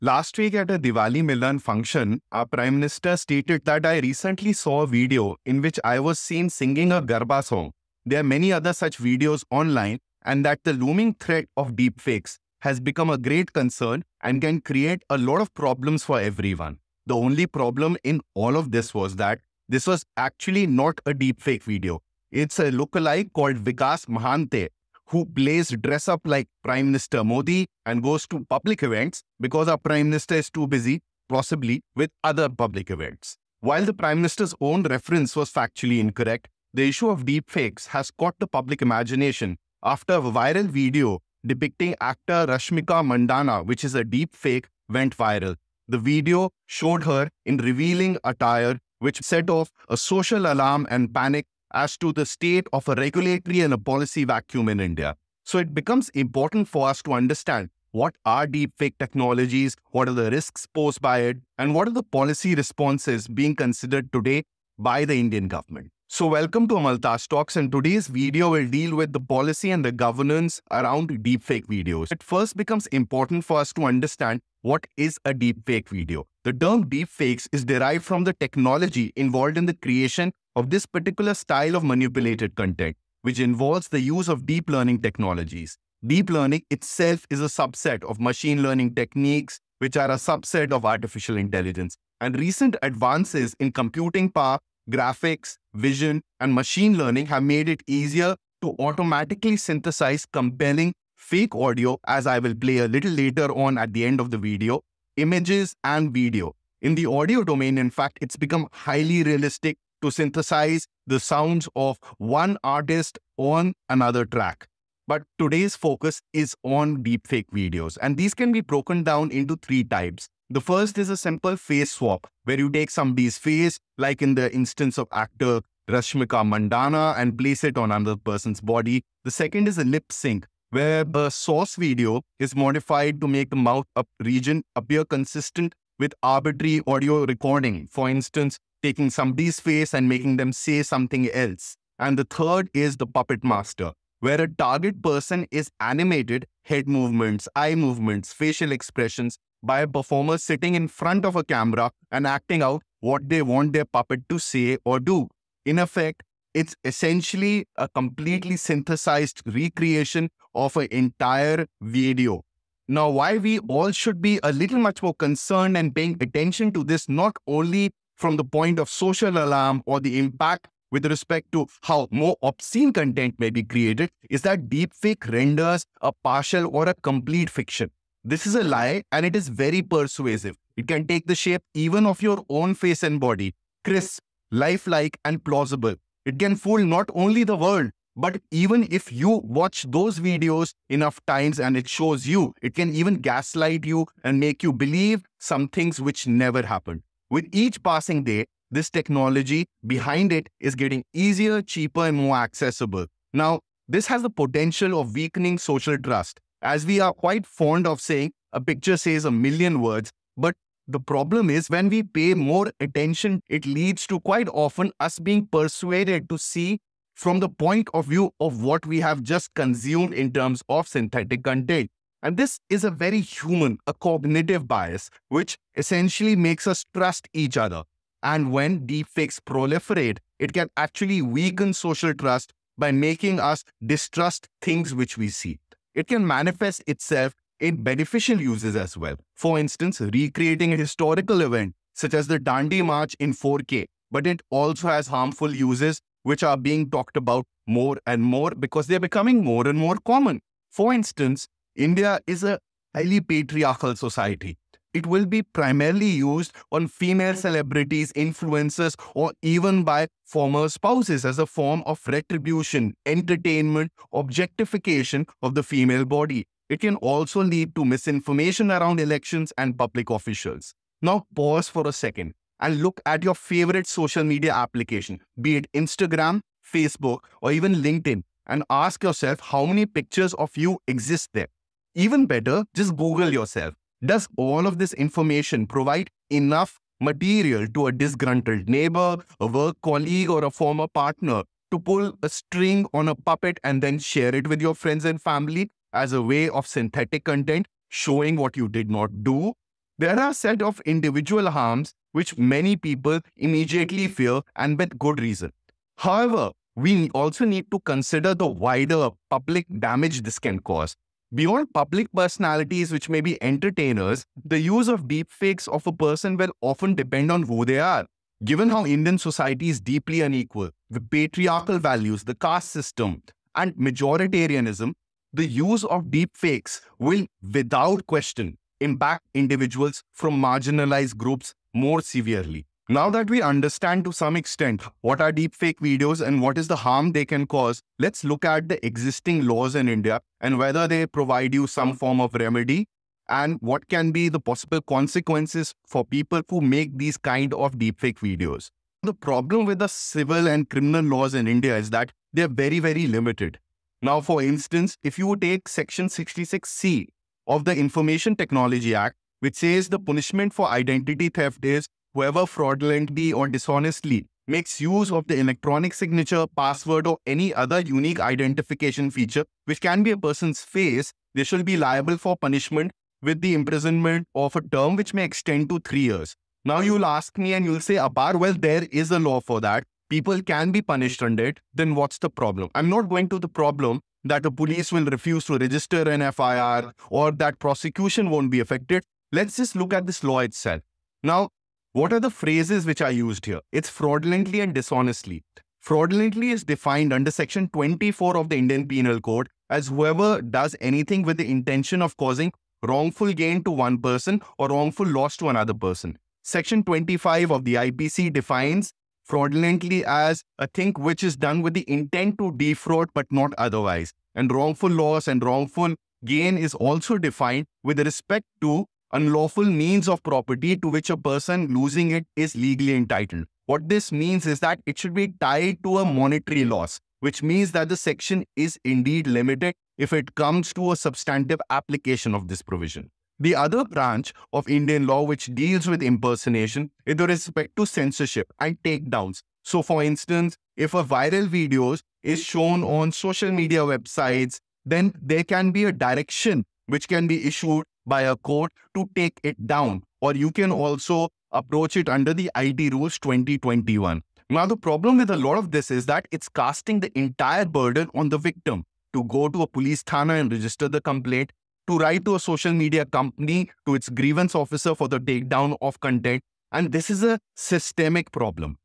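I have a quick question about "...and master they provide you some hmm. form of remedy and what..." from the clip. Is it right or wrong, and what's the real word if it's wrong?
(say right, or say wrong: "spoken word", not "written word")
wrong: "whether", not "master".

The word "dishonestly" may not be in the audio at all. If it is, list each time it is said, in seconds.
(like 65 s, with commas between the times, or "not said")
363 s, 394 s.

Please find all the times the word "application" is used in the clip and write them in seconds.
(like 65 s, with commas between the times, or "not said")
274 s, 431 s.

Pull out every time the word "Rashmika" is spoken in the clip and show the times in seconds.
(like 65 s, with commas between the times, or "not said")
42 s, 125 s.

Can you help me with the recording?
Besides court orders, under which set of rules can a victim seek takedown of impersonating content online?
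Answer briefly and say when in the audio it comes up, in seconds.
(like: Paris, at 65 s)
IT rules 2021, at 452 s.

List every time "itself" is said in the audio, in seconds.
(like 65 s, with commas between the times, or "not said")
86 s, 236 s, 390 s.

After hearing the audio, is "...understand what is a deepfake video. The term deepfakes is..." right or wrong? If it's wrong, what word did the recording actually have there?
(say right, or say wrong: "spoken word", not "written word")
right.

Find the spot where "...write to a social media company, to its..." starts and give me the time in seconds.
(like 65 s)
461 s.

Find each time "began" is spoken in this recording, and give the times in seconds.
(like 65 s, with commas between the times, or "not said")
not said.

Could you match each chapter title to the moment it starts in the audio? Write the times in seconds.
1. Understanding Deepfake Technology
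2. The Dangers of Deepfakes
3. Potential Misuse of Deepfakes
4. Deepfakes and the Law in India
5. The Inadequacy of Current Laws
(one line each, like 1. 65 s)
1. 71 s
2. 161 s
3. 249 s
4. 336 s
5. 348 s.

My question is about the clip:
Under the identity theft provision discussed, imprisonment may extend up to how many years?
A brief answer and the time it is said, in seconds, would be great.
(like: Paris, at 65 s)
3 years, at 375 s.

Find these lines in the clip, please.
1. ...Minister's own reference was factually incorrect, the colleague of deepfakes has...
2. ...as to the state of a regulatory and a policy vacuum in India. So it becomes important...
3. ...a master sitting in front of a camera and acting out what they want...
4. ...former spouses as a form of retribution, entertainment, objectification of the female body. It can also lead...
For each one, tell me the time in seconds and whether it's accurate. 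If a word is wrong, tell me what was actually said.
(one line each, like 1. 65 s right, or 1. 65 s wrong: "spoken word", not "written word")
1. 34 s wrong: "issue", not "colleague"
2. 51 s right
3. 149 s wrong: "performer", not "master"
4. 260 s right.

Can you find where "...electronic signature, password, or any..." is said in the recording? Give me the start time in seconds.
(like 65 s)
365 s.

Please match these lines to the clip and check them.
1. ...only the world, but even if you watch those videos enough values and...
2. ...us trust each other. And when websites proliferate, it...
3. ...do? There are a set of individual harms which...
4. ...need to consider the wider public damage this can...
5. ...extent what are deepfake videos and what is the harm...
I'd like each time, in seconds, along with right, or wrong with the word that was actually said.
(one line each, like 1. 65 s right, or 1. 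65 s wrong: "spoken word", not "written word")
1. 187 s wrong: "times", not "values"
2. 226 s wrong: "deepfakes", not "websites"
3. 299 s right
4. 307 s right
5. 334 s right.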